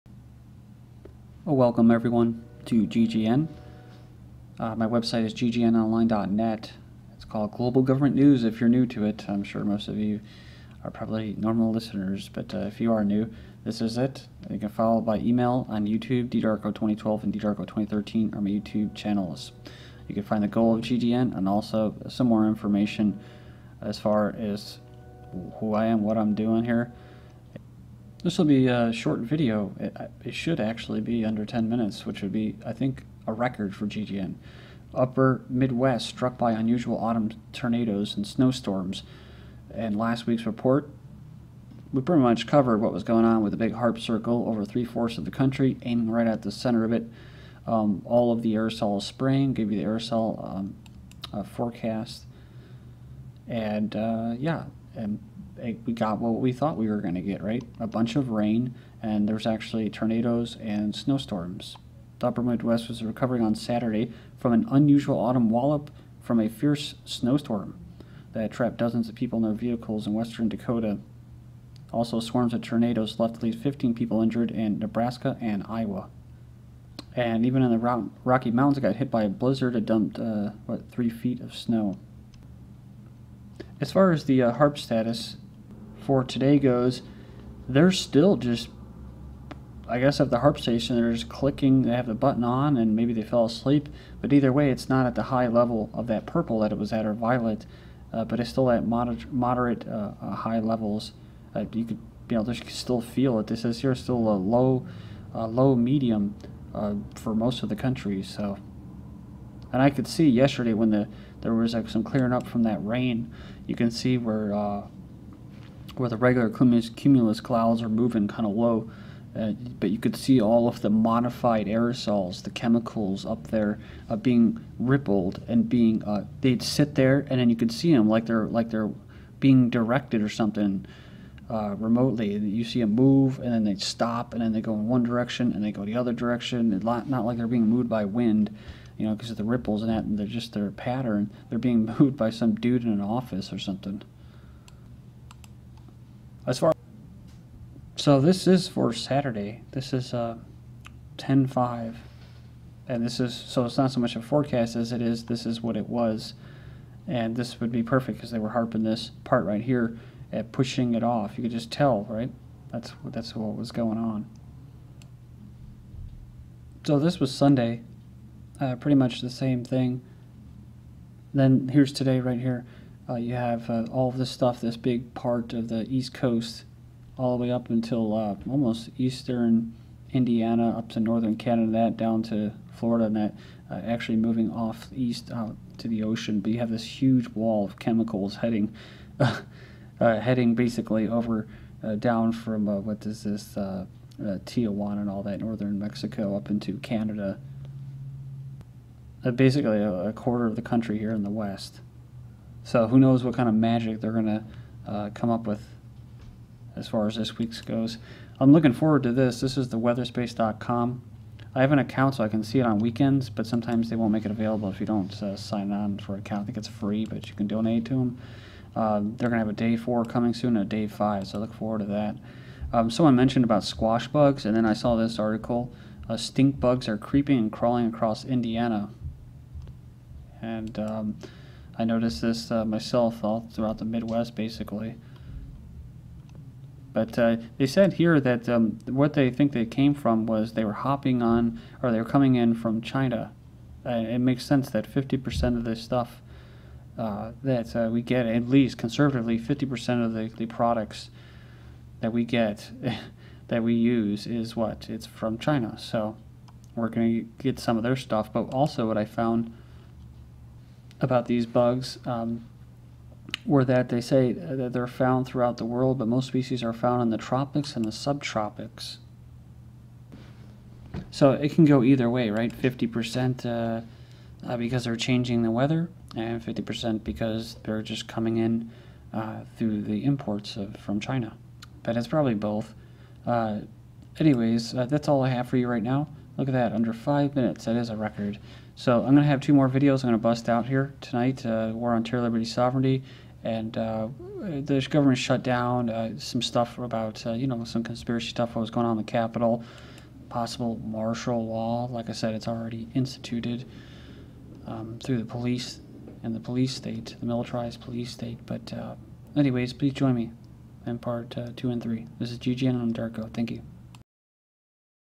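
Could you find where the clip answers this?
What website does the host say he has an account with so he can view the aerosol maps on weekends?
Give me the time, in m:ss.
3:29.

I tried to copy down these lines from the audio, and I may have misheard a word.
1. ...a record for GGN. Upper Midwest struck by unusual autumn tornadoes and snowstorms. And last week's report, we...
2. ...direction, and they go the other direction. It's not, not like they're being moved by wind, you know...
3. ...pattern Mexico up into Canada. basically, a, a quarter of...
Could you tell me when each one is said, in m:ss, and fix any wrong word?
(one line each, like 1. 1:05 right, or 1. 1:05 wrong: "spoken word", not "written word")
1. 0:33 right
2. 2:15 right
3. 3:15 wrong: "northern", not "pattern".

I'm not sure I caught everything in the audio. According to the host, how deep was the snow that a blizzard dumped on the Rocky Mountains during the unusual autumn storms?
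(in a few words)
3 feet.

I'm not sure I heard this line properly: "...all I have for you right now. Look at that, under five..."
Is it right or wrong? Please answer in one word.
right.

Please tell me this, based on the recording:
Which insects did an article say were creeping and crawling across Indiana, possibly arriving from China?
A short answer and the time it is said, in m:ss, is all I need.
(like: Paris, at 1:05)
Stink bugs, at 3:46.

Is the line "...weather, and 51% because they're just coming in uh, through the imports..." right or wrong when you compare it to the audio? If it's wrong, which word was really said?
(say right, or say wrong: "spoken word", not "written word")
wrong: "50", not "51".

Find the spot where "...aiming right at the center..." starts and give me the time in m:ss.
0:45.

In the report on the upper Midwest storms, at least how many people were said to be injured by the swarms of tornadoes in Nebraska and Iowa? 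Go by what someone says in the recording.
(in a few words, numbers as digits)
15.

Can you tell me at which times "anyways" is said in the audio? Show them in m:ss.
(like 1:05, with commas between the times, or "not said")
4:44, 5:09.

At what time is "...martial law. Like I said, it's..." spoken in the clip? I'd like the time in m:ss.
5:00.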